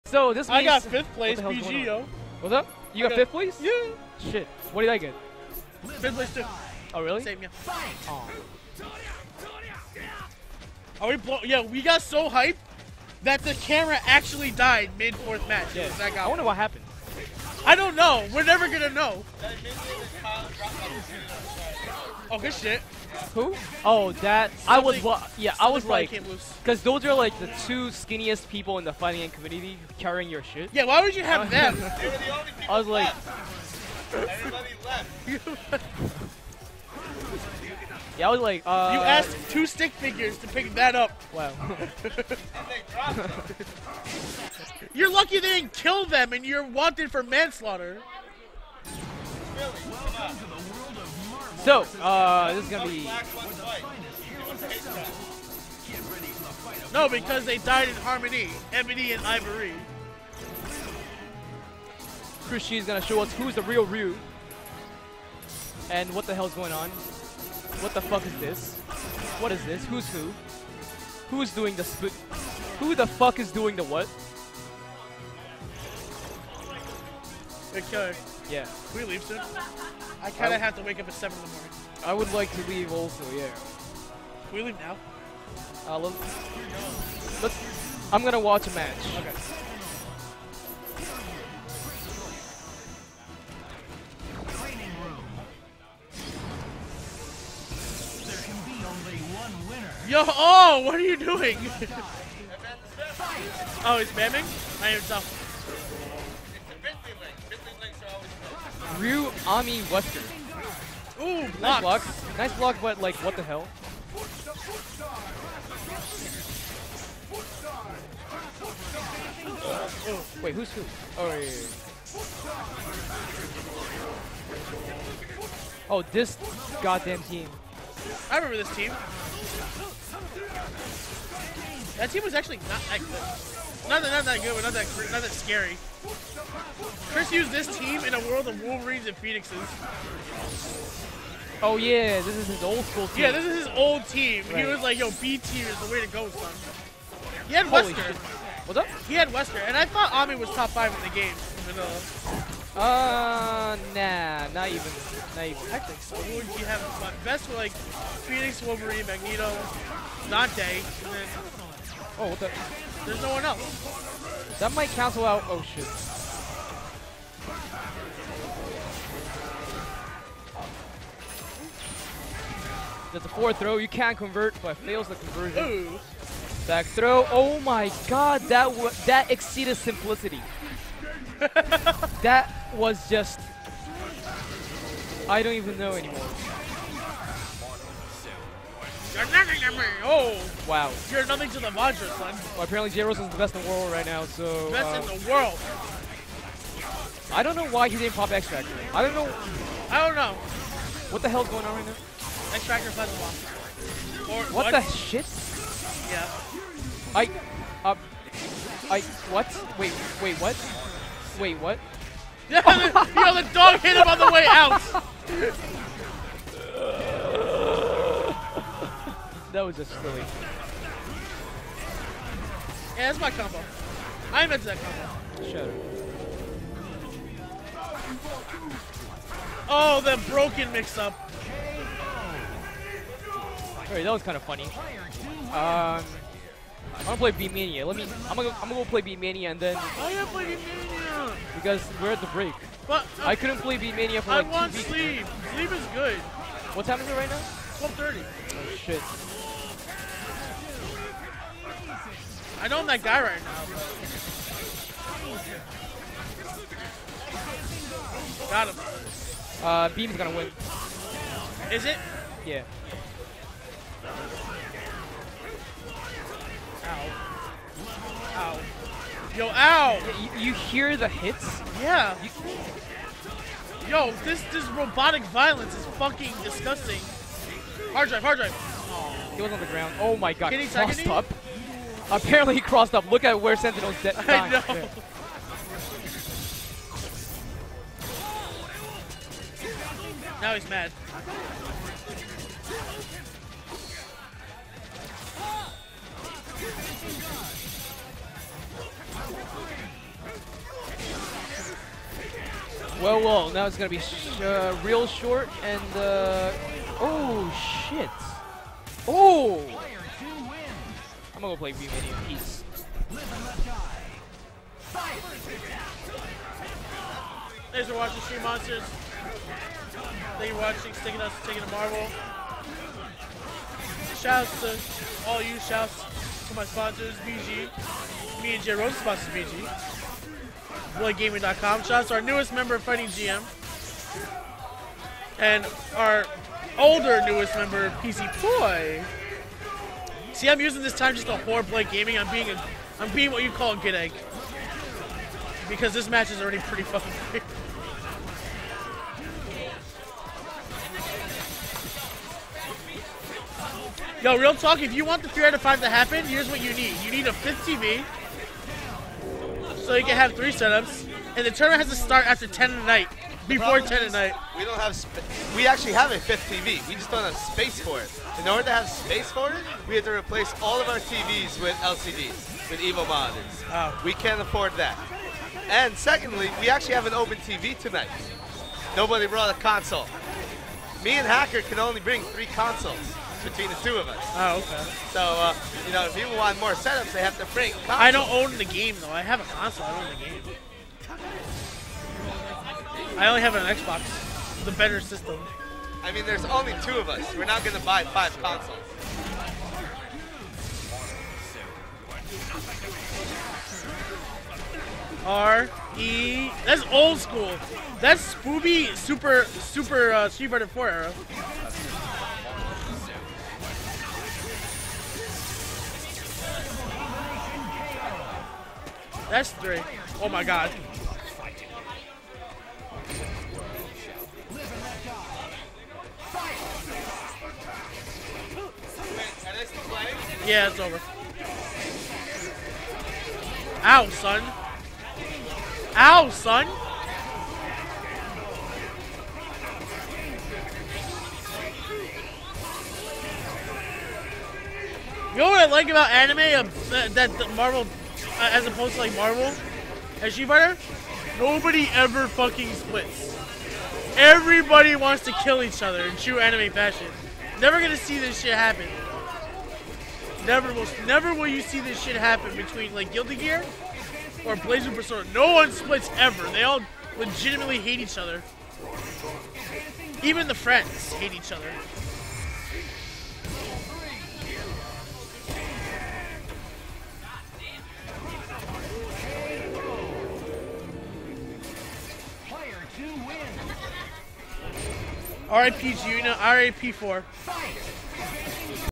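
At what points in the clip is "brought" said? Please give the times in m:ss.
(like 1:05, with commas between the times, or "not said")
6:19.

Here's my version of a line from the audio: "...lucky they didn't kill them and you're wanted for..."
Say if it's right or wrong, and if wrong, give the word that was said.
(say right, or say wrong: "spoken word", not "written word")
right.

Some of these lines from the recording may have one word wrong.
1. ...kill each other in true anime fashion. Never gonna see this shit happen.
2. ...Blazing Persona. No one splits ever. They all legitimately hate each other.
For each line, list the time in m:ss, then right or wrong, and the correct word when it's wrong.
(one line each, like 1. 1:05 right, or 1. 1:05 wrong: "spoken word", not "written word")
1. 7:35 right
2. 7:44 right.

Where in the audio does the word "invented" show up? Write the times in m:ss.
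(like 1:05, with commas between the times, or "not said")
3:44.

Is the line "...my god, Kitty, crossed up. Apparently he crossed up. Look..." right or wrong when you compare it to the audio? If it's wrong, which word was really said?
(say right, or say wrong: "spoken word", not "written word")
right.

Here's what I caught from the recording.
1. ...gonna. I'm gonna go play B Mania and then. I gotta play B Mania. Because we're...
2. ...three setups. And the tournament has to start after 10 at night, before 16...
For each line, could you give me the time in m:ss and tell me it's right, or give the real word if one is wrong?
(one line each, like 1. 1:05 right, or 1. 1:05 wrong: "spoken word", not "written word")
1. 3:58 right
2. 6:00 wrong: "10", not "16".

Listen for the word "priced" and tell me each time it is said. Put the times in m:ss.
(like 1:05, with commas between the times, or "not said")
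not said.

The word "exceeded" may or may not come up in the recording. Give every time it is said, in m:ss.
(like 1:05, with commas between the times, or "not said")
2:59.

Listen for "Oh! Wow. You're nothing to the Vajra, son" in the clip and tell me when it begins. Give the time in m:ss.
3:10.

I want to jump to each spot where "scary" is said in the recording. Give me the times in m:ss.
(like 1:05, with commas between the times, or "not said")
2:15.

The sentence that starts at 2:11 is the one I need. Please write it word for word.
That team was actually not that good.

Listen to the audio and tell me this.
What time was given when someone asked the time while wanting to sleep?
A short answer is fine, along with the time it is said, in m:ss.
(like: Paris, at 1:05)
12:30, at 4:07.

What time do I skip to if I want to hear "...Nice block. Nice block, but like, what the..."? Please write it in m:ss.
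1:51.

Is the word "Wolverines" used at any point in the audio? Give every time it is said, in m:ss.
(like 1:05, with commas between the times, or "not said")
2:18, 2:38.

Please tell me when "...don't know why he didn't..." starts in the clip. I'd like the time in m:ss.
3:17.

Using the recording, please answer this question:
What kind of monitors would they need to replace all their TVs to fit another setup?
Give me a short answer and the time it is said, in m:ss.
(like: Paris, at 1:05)
EVO monitors, at 6:12.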